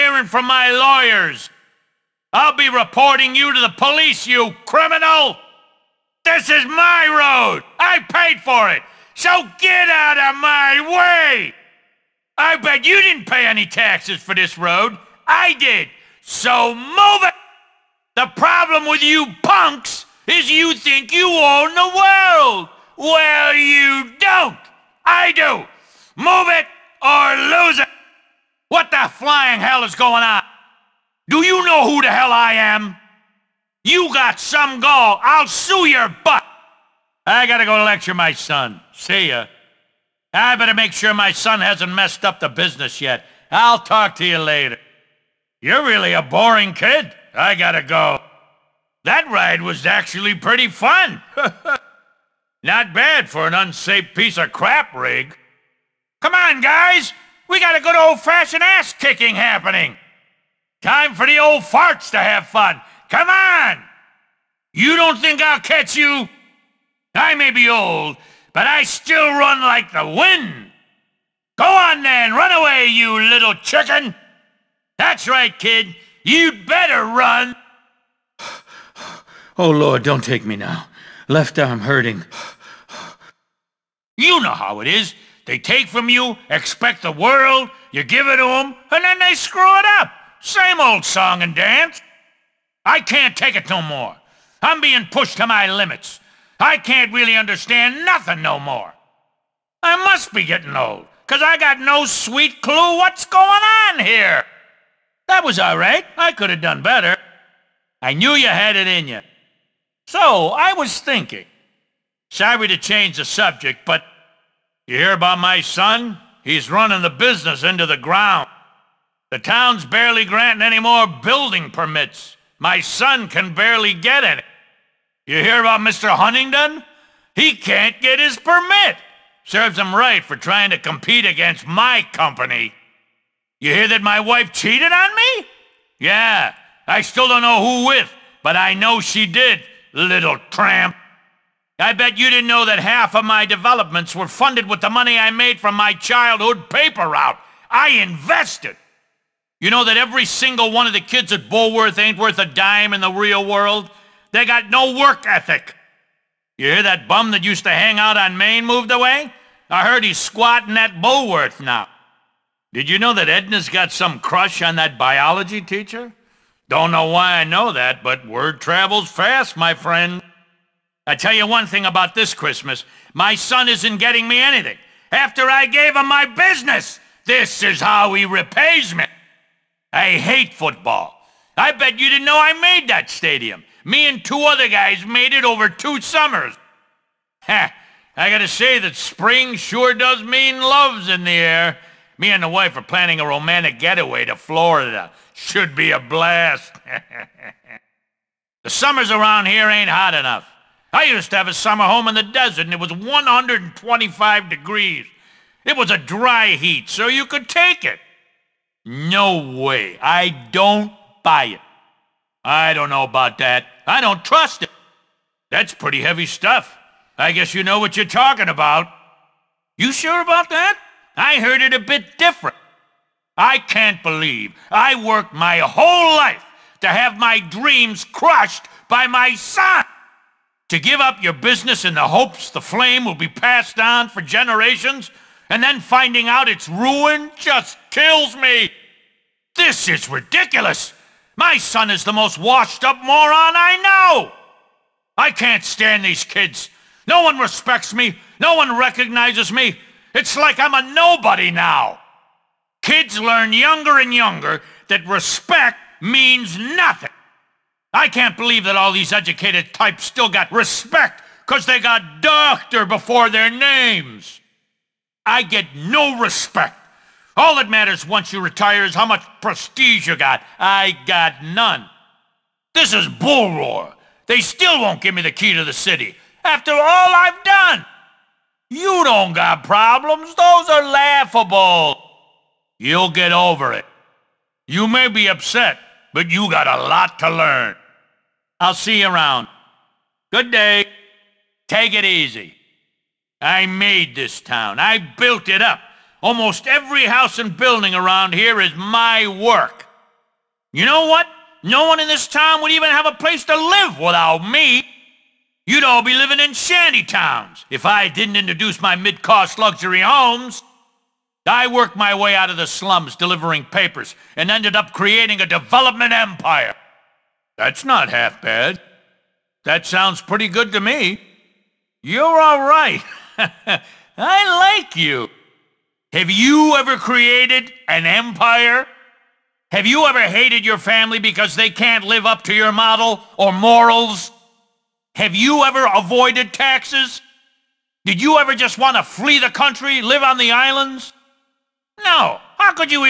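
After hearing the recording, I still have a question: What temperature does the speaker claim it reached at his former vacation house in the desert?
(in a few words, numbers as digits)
125 degrees.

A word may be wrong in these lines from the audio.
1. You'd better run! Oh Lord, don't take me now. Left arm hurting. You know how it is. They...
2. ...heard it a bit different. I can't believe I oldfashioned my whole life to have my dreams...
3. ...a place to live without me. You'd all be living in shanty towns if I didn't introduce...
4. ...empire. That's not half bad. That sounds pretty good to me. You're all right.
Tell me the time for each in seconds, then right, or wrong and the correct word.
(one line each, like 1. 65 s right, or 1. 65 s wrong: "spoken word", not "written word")
1. 76 s right
2. 221 s wrong: "worked", not "oldfashioned"
3. 303 s right
4. 316 s right.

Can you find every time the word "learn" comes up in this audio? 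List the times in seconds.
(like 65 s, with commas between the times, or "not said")
253 s, 287 s.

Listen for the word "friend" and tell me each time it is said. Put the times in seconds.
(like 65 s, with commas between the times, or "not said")
169 s.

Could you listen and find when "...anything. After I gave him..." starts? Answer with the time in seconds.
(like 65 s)
174 s.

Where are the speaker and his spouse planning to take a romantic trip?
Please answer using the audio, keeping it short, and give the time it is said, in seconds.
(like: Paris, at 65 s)
Florida, at 194 s.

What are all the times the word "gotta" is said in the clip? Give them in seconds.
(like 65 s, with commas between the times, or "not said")
37 s, 47 s, 188 s.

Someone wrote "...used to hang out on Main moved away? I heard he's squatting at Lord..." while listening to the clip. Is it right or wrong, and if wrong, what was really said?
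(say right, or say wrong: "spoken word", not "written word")
wrong: "Bullworth", not "Lord".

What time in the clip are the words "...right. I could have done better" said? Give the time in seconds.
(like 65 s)
105 s.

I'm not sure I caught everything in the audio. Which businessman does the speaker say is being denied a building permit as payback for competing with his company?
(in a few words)
Mr. Huntingdon.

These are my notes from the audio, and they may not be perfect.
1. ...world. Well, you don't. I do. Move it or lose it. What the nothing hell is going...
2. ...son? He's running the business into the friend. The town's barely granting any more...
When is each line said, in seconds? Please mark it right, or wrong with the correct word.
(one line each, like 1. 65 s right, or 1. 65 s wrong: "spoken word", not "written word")
1. 21 s wrong: "flying", not "nothing"
2. 115 s wrong: "ground", not "friend".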